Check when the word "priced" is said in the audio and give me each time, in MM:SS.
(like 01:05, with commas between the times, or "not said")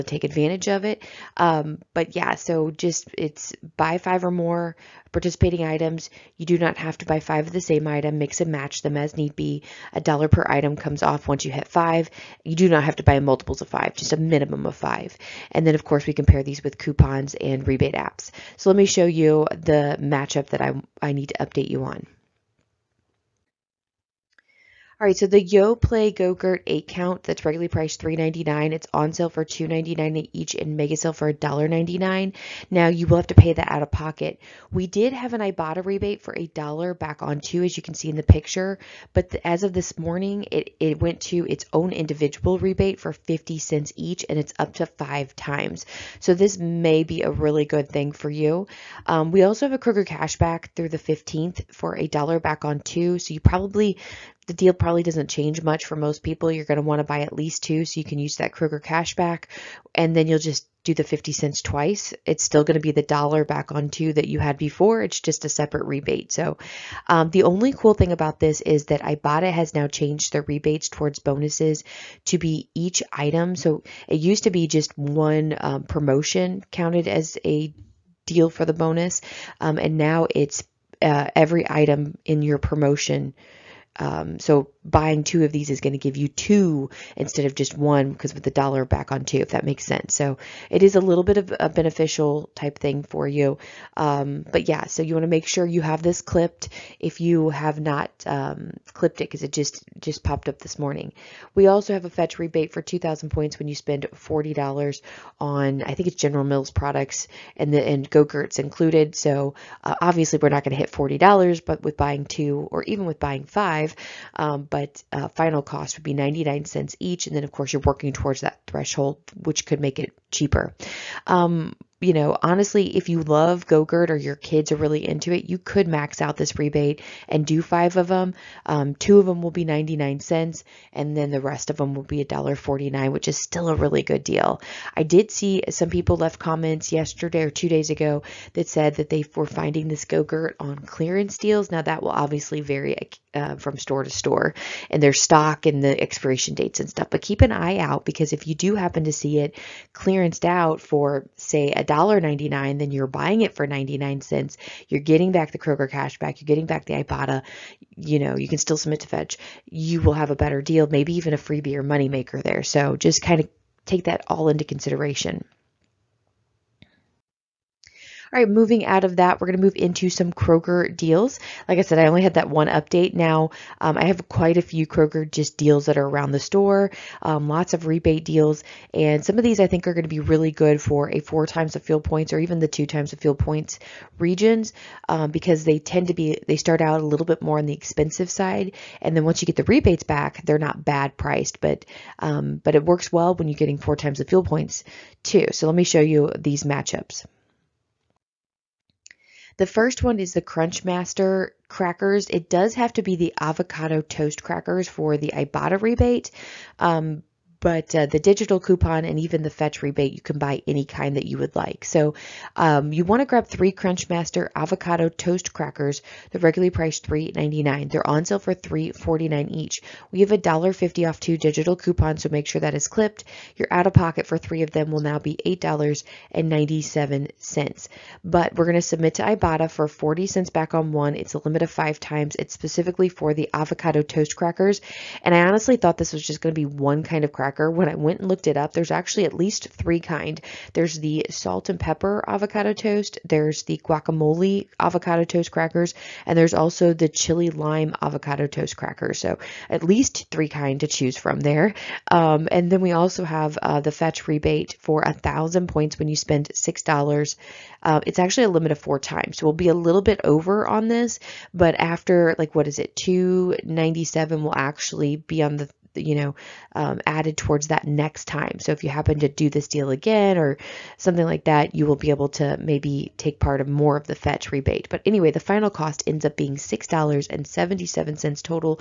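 00:27, 03:11, 03:36.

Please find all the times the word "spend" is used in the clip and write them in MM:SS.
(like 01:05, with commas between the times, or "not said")
01:43, 04:16.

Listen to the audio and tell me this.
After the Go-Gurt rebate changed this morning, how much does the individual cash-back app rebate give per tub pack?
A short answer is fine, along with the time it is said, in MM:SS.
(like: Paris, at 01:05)
50 cents, at 00:43.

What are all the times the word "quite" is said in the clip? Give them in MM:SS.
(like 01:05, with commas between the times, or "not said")
02:54.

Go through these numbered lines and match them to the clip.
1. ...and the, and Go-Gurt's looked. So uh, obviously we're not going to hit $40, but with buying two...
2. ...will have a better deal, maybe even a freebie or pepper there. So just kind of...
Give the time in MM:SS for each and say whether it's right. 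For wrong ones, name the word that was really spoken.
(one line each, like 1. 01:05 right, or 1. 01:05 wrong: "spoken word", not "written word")
1. 01:47 wrong: "included", not "looked"
2. 02:40 wrong: "moneymaker", not "pepper".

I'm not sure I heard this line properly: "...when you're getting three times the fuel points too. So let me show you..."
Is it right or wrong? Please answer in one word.
wrong.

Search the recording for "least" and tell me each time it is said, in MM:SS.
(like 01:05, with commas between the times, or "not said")
00:57, 03:59, 04:09.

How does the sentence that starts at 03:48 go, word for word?
But we're going to submit to Ibotta for 40 cents back on one.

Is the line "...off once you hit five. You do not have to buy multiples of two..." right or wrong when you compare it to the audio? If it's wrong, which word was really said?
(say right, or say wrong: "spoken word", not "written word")
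wrong: "five", not "two".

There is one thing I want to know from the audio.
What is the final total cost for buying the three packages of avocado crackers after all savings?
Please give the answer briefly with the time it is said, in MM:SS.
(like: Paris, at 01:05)
$6.77, at 04:36.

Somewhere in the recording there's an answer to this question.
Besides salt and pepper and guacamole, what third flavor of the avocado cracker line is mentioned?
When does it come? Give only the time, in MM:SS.
04:07.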